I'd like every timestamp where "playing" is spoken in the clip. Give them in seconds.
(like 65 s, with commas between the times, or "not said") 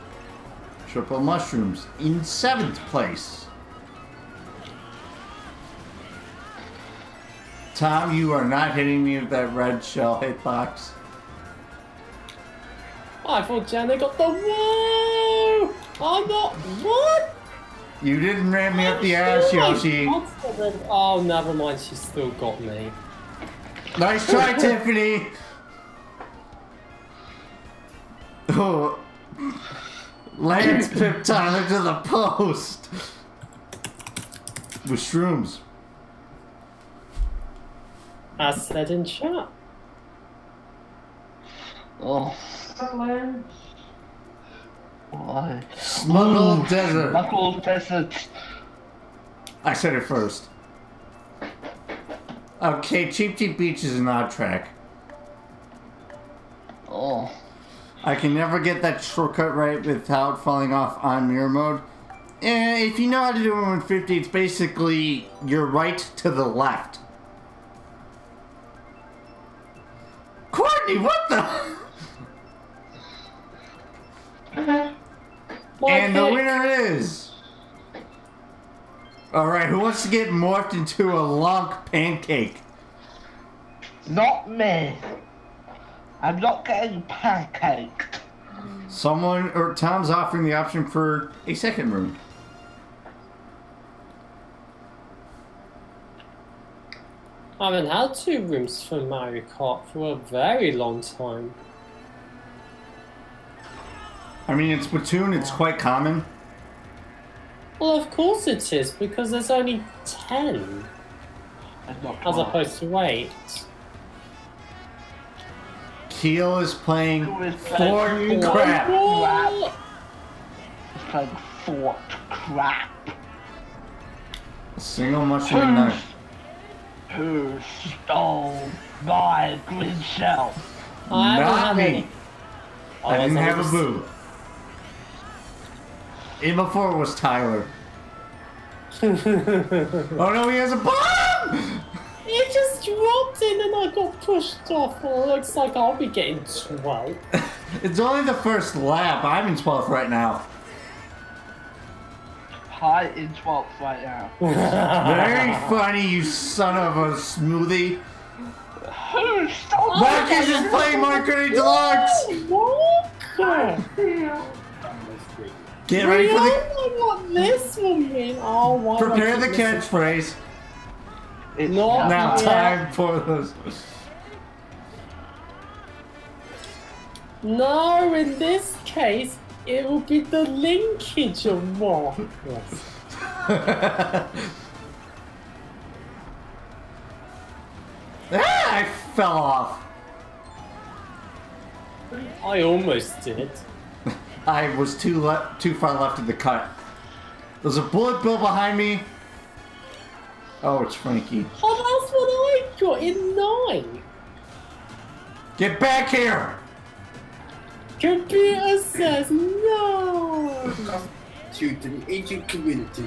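116 s, 121 s, 160 s.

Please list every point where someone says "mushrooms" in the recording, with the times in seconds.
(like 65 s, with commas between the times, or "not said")
1 s, 125 s.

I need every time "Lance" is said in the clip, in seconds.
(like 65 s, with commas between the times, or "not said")
30 s, 42 s.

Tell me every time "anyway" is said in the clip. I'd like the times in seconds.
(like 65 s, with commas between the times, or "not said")
not said.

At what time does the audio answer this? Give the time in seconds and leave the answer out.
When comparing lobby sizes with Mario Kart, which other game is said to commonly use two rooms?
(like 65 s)
104 s.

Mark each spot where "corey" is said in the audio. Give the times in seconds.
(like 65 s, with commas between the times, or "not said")
not said.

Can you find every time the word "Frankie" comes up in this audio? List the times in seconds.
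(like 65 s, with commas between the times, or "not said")
200 s.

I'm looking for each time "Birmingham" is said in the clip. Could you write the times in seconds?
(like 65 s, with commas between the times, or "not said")
not said.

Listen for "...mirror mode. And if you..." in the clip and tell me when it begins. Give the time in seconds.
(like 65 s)
61 s.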